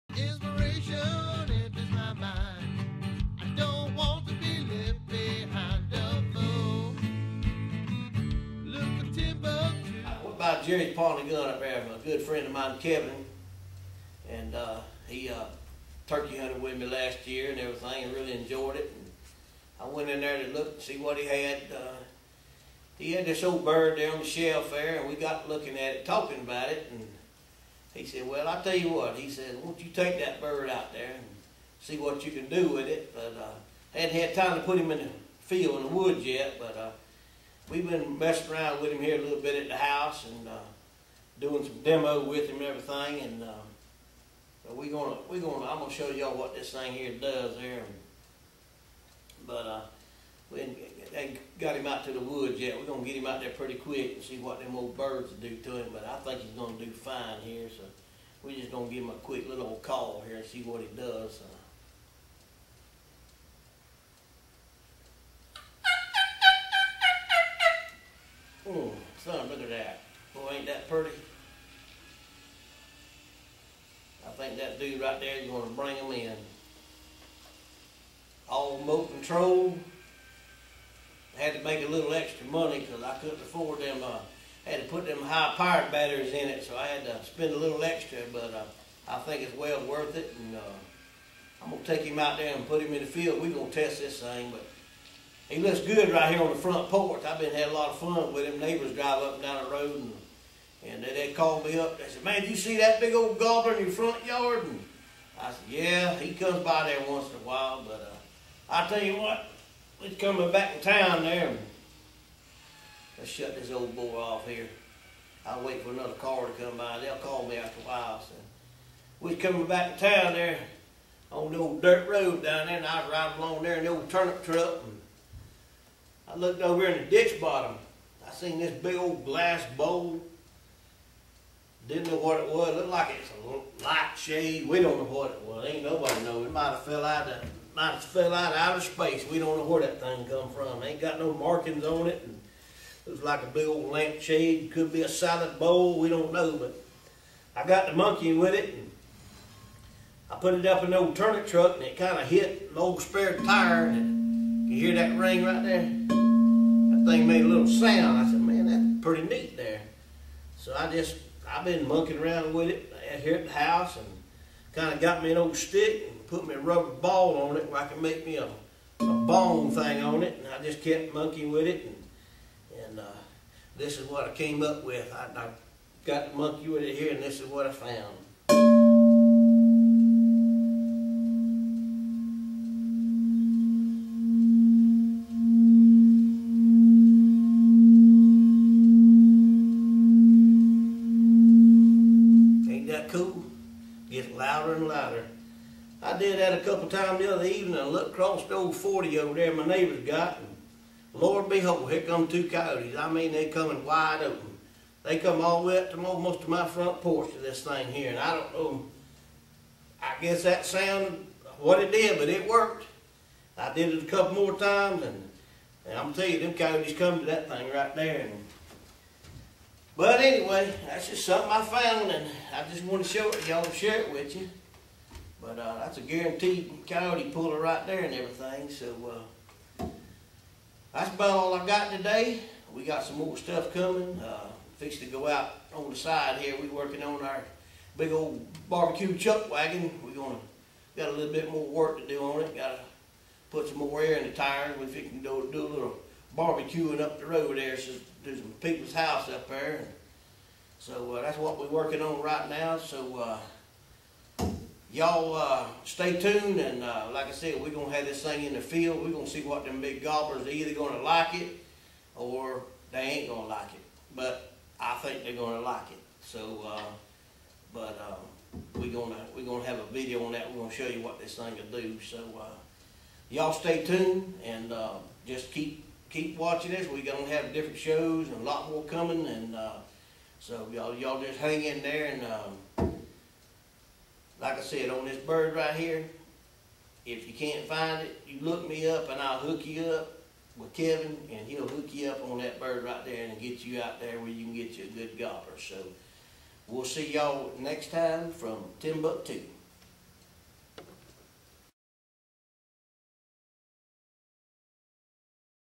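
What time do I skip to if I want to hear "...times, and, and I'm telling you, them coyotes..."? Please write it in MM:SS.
03:34.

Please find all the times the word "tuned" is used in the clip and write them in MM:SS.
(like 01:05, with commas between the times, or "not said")
04:16, 04:33.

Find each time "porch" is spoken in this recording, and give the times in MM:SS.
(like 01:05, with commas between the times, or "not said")
01:36, 03:27.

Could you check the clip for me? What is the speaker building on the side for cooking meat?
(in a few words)
barbecue chuck wagon.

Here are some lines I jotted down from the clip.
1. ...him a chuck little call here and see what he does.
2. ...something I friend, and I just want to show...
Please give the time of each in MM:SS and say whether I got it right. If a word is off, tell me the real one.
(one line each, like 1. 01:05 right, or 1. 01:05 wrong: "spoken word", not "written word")
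1. 00:59 wrong: "quick", not "chuck"
2. 03:41 wrong: "found", not "friend".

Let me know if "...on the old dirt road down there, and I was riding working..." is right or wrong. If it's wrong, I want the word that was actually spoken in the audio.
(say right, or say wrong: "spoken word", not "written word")
wrong: "along", not "working".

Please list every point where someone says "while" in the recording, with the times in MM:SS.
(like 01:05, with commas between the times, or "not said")
01:47, 01:57.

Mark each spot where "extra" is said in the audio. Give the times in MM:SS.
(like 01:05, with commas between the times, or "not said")
01:22, 01:27.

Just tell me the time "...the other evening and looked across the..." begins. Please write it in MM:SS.
03:17.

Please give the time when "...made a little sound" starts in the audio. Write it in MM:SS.
02:37.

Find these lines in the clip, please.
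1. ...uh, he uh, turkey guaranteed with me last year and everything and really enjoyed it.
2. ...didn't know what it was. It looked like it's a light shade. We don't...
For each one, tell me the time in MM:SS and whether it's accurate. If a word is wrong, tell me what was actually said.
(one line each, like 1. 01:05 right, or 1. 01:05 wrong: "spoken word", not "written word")
1. 00:14 wrong: "hunted", not "guaranteed"
2. 02:11 right.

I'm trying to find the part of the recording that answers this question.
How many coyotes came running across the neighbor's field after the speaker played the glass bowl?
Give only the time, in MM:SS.
03:22.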